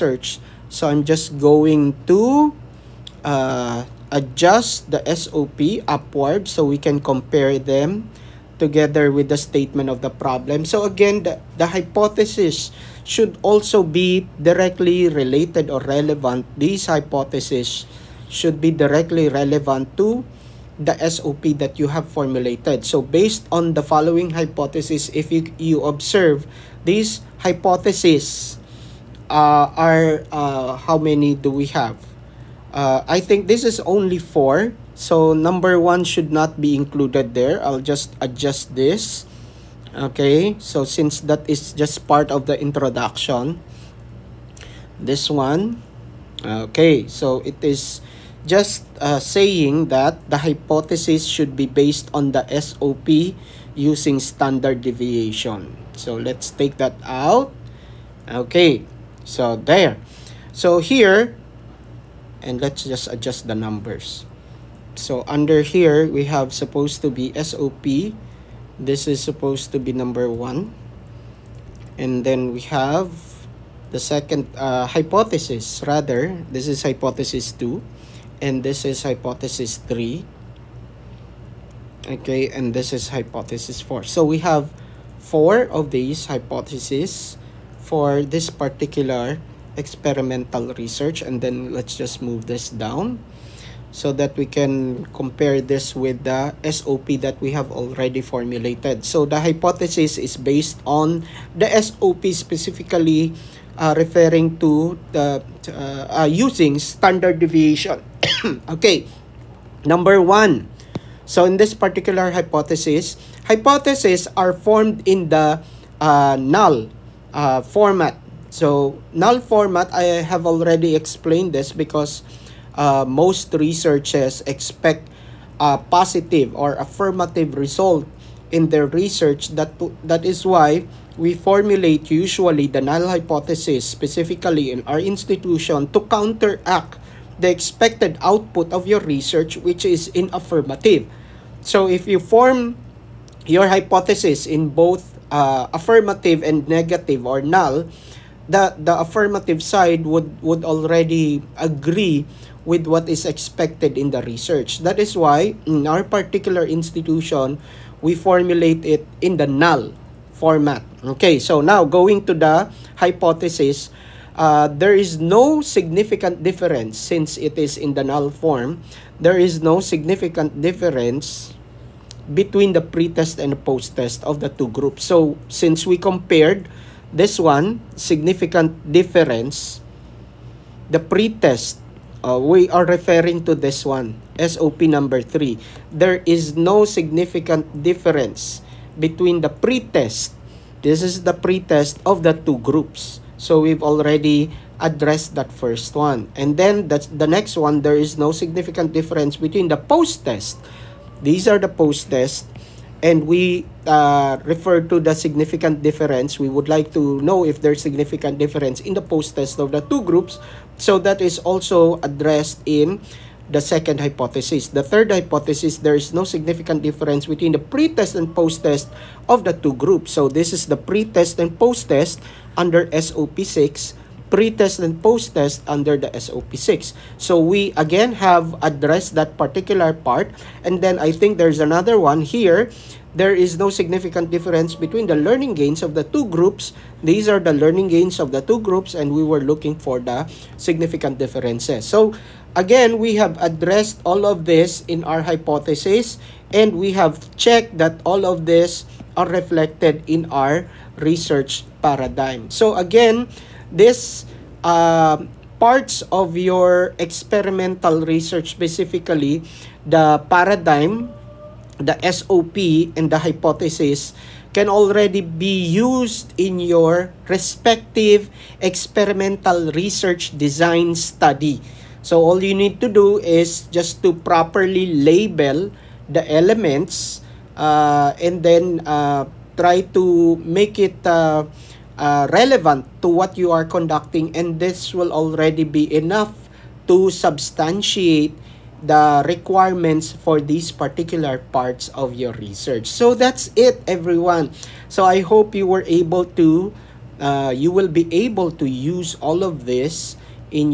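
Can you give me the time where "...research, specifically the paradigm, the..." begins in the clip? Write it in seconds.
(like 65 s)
258 s.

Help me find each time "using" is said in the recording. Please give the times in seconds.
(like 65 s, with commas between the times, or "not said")
53 s, 106 s.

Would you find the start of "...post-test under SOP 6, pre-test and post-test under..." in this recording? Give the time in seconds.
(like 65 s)
221 s.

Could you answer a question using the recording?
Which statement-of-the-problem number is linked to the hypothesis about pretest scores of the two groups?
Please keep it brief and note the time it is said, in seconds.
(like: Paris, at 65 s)
3, at 184 s.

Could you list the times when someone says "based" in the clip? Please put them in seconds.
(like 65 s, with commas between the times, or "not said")
23 s, 51 s, 100 s.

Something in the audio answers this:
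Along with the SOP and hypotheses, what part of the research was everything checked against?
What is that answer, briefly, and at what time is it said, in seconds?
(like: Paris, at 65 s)
research paradigm, at 250 s.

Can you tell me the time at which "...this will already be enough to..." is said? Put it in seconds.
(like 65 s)
284 s.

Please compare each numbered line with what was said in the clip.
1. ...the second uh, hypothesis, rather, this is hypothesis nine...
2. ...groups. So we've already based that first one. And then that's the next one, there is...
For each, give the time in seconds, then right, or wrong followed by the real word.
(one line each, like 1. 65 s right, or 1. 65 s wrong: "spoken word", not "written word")
1. 73 s wrong: "two", not "nine"
2. 192 s wrong: "addressed", not "based".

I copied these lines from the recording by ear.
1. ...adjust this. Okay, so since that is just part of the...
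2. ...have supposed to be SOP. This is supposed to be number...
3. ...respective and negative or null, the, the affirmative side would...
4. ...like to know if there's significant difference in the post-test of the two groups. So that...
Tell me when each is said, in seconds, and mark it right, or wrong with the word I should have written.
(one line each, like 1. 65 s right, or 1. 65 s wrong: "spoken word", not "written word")
1. 38 s right
2. 66 s right
3. 145 s wrong: "affirmative", not "respective"
4. 206 s right.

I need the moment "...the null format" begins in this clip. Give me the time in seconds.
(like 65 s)
159 s.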